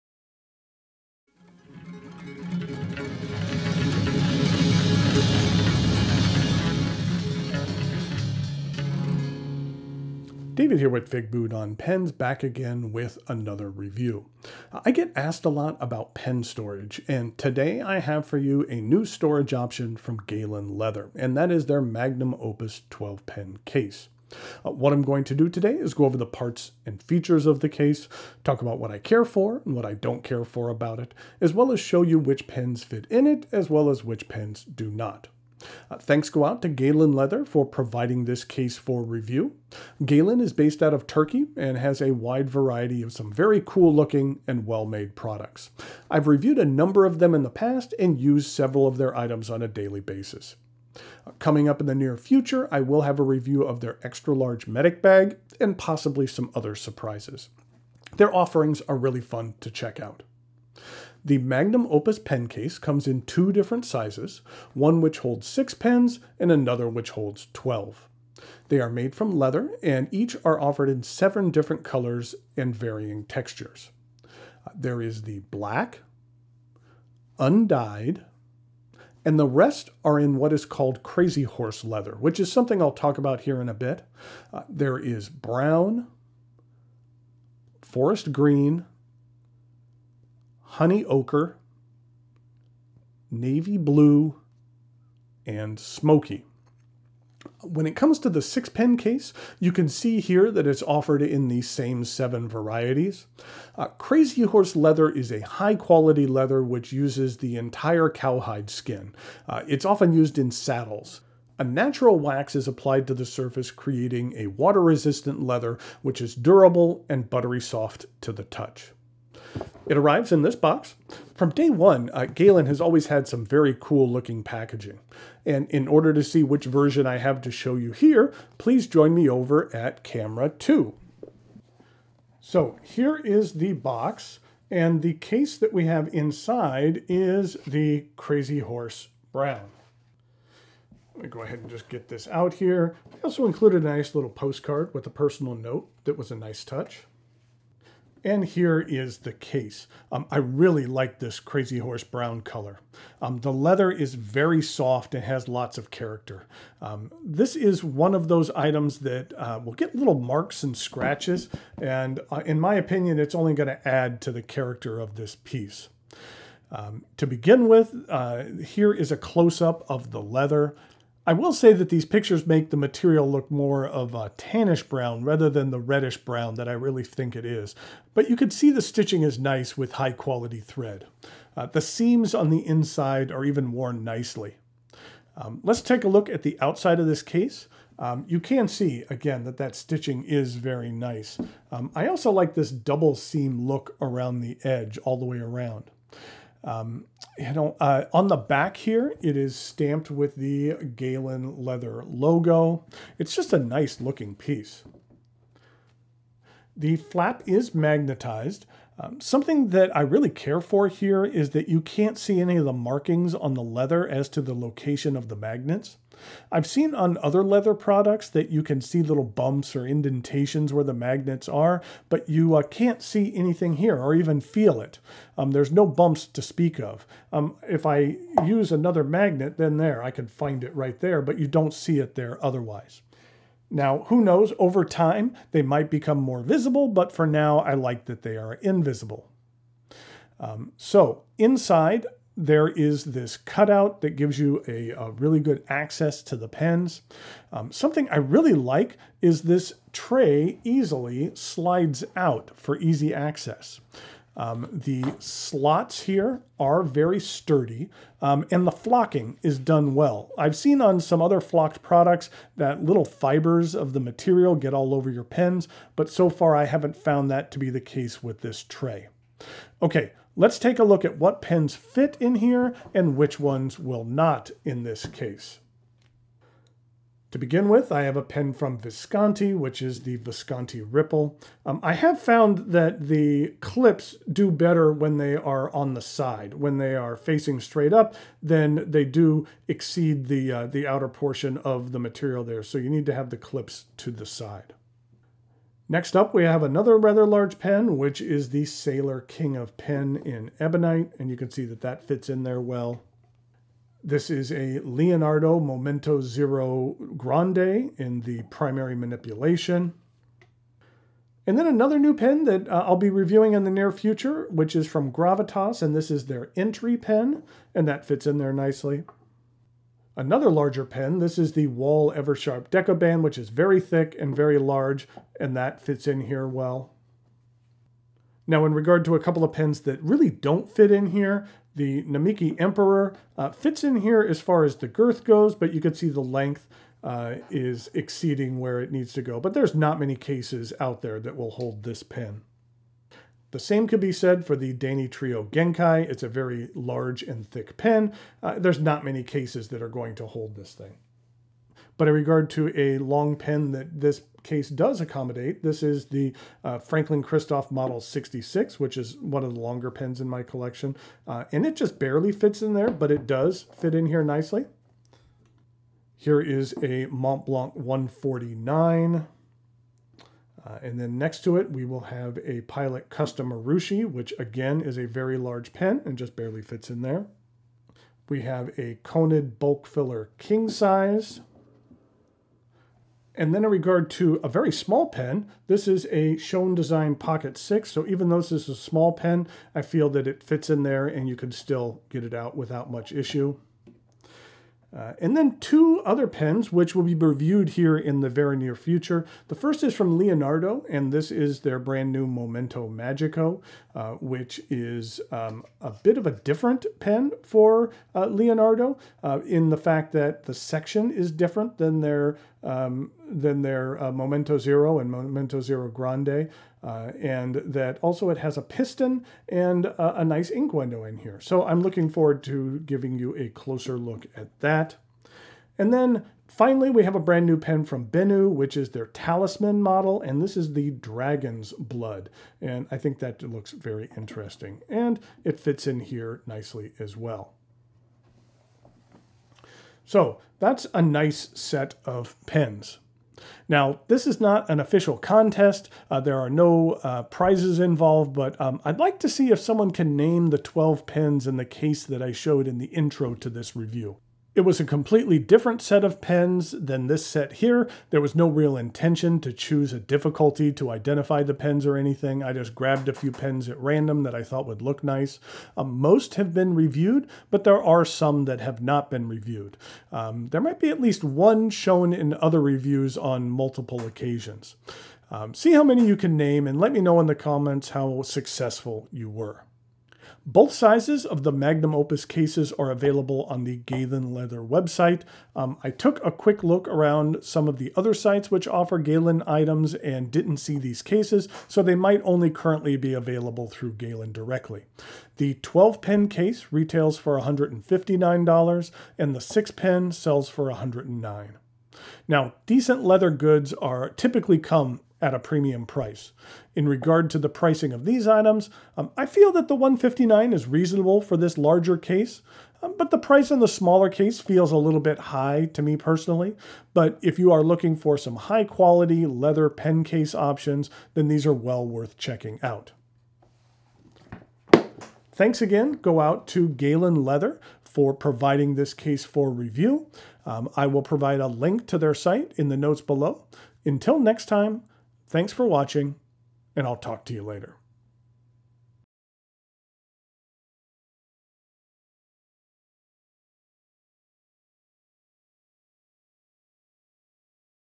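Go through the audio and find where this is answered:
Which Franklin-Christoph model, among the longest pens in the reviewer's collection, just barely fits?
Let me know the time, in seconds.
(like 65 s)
357 s.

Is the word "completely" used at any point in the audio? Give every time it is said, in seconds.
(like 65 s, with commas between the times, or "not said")
454 s.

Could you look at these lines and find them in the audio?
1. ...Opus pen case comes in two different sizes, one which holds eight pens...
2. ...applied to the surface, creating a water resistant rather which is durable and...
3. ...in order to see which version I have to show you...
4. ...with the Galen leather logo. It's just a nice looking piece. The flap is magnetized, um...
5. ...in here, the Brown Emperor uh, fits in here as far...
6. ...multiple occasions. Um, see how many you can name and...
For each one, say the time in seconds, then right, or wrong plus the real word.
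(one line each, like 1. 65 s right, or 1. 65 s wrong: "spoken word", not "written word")
1. 61 s wrong: "six", not "eight"
2. 112 s wrong: "leather", not "rather"
3. 125 s right
4. 200 s right
5. 330 s wrong: "Namiki", not "Brown"
6. 473 s right.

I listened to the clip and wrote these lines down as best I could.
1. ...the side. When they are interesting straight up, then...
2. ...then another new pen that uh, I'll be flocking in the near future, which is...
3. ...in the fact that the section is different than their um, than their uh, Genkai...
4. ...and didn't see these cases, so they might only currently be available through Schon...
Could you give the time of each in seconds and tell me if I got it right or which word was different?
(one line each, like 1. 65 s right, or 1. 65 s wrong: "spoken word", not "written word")
1. 285 s wrong: "facing", not "interesting"
2. 311 s wrong: "reviewing", not "flocking"
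3. 409 s wrong: "Momento", not "Genkai"
4. 489 s wrong: "Galen", not "Schon".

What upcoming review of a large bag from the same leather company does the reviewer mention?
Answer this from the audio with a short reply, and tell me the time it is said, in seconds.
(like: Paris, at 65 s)
extra large medic bag, at 54 s.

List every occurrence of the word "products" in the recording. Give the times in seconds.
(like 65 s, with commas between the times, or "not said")
45 s, 217 s, 261 s.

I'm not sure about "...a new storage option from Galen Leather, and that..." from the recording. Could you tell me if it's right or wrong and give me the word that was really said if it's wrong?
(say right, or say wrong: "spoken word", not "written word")
right.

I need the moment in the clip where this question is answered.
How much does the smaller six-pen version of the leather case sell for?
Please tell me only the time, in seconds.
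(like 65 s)
500 s.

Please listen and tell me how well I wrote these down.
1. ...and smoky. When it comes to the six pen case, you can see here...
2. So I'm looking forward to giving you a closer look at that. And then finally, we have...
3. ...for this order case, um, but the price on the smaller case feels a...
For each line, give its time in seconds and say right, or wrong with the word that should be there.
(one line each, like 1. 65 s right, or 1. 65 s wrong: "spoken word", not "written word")
1. 95 s right
2. 421 s right
3. 511 s wrong: "larger", not "order".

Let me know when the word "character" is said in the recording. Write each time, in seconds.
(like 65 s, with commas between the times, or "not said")
155 s, 164 s.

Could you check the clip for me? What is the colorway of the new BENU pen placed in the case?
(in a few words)
Dragon's Blood.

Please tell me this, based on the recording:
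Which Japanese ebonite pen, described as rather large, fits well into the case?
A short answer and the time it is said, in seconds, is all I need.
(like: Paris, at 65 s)
Sailor King of Pen, at 298 s.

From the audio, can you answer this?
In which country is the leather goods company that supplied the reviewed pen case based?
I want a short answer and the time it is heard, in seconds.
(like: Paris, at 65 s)
Turkey, at 41 s.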